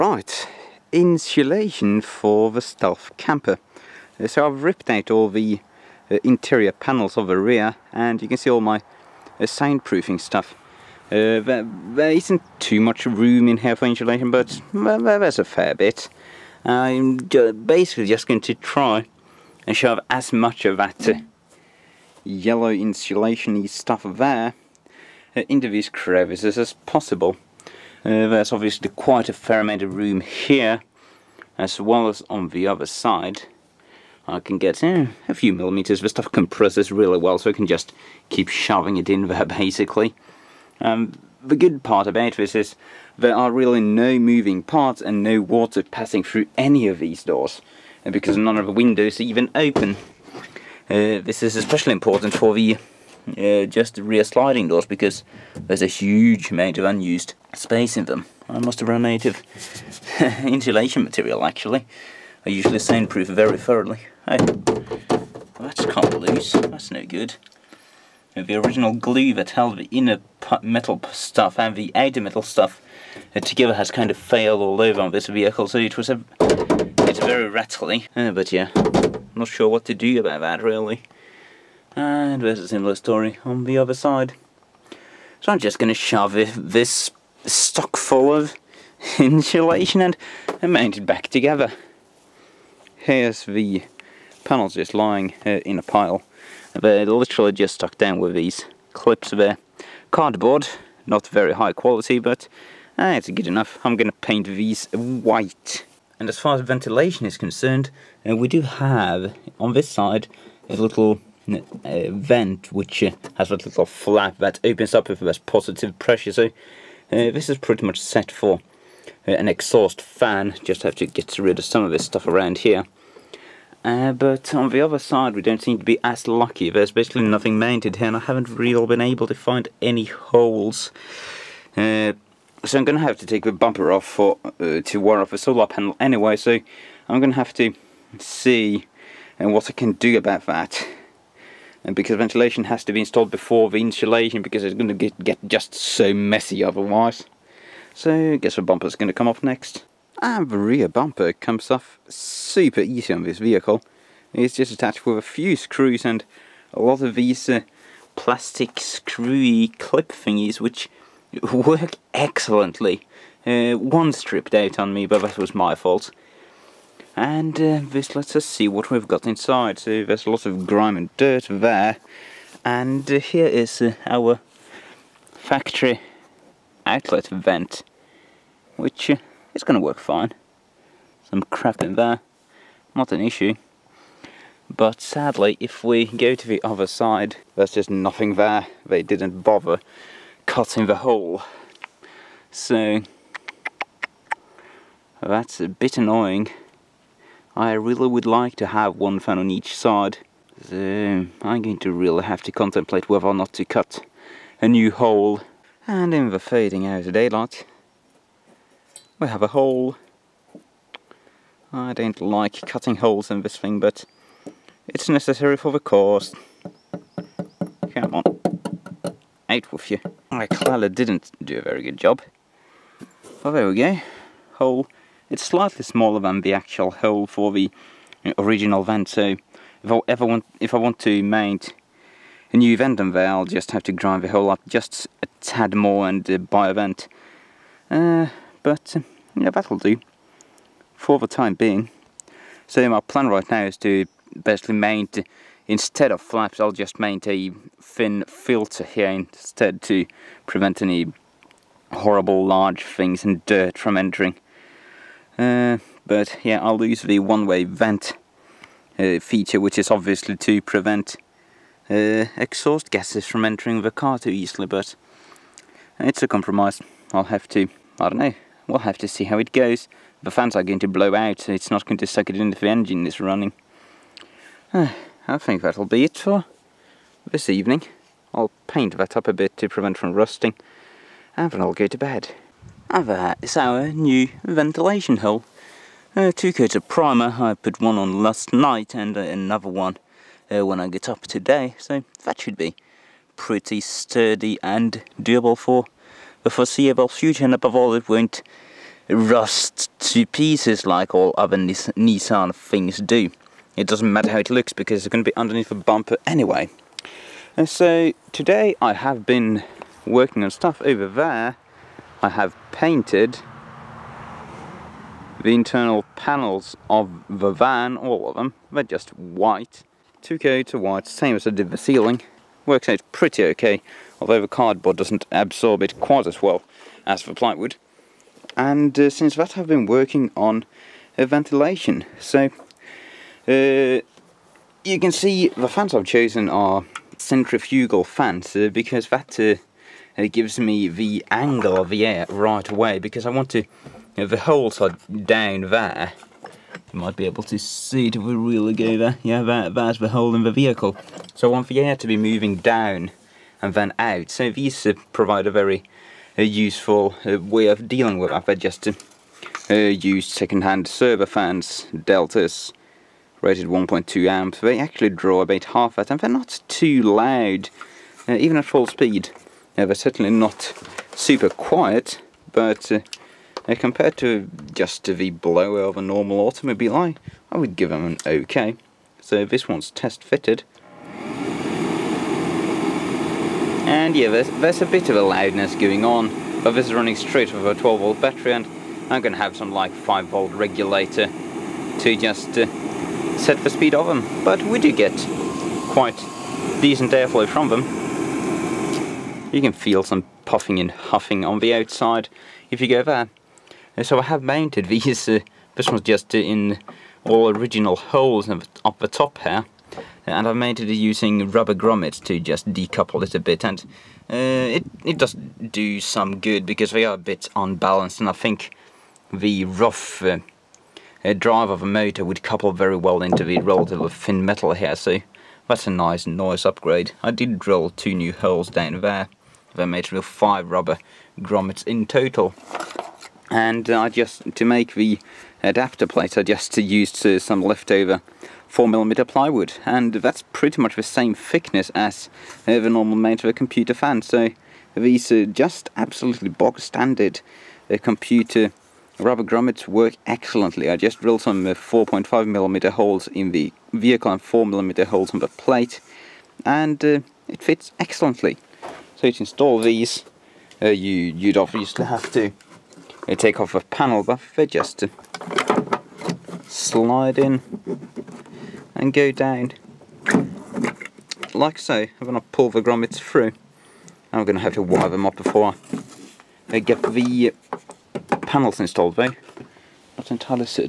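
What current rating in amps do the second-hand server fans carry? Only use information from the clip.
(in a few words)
1.2 amps.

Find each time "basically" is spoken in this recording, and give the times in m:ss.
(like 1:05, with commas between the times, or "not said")
0:17, 0:39, 2:06, 4:04.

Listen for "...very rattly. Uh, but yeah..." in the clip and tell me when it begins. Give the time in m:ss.
1:17.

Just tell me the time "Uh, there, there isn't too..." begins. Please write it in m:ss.
0:11.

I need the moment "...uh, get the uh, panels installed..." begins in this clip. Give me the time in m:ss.
7:56.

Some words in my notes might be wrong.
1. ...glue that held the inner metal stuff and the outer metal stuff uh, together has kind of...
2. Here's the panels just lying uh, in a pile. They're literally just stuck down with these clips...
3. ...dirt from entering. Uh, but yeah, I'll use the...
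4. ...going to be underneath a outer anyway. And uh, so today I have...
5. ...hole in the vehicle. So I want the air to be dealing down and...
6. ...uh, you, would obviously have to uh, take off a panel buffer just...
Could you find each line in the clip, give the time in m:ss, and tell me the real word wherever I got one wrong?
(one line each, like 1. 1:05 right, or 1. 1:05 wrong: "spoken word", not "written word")
1. 1:08 right
2. 1:32 right
3. 4:13 right
4. 5:05 wrong: "bumper", not "outer"
5. 5:50 wrong: "moving", not "dealing"
6. 7:40 right.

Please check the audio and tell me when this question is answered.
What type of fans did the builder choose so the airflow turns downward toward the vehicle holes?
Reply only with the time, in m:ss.
5:37.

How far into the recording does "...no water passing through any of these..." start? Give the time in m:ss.
0:45.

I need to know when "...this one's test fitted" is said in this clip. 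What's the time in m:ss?
6:19.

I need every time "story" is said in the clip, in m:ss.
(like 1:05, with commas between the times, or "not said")
1:22.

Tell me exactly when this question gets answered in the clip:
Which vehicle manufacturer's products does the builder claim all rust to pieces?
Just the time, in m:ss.
5:01.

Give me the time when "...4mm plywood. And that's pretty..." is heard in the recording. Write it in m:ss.
7:18.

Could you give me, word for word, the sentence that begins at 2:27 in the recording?
So I guess the bumper is going to come off next.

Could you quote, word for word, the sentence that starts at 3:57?
Uh, but uh, yeah, that'll do for the time being.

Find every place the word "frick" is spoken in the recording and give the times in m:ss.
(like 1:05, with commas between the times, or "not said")
not said.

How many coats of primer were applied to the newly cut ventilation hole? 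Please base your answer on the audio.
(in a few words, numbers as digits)
2.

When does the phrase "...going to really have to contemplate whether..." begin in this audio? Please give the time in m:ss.
3:21.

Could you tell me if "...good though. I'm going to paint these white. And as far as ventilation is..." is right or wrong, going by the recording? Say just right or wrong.
wrong.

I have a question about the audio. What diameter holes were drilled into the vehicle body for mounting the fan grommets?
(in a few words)
4.5mm.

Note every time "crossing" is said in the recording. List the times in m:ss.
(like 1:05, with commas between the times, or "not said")
not said.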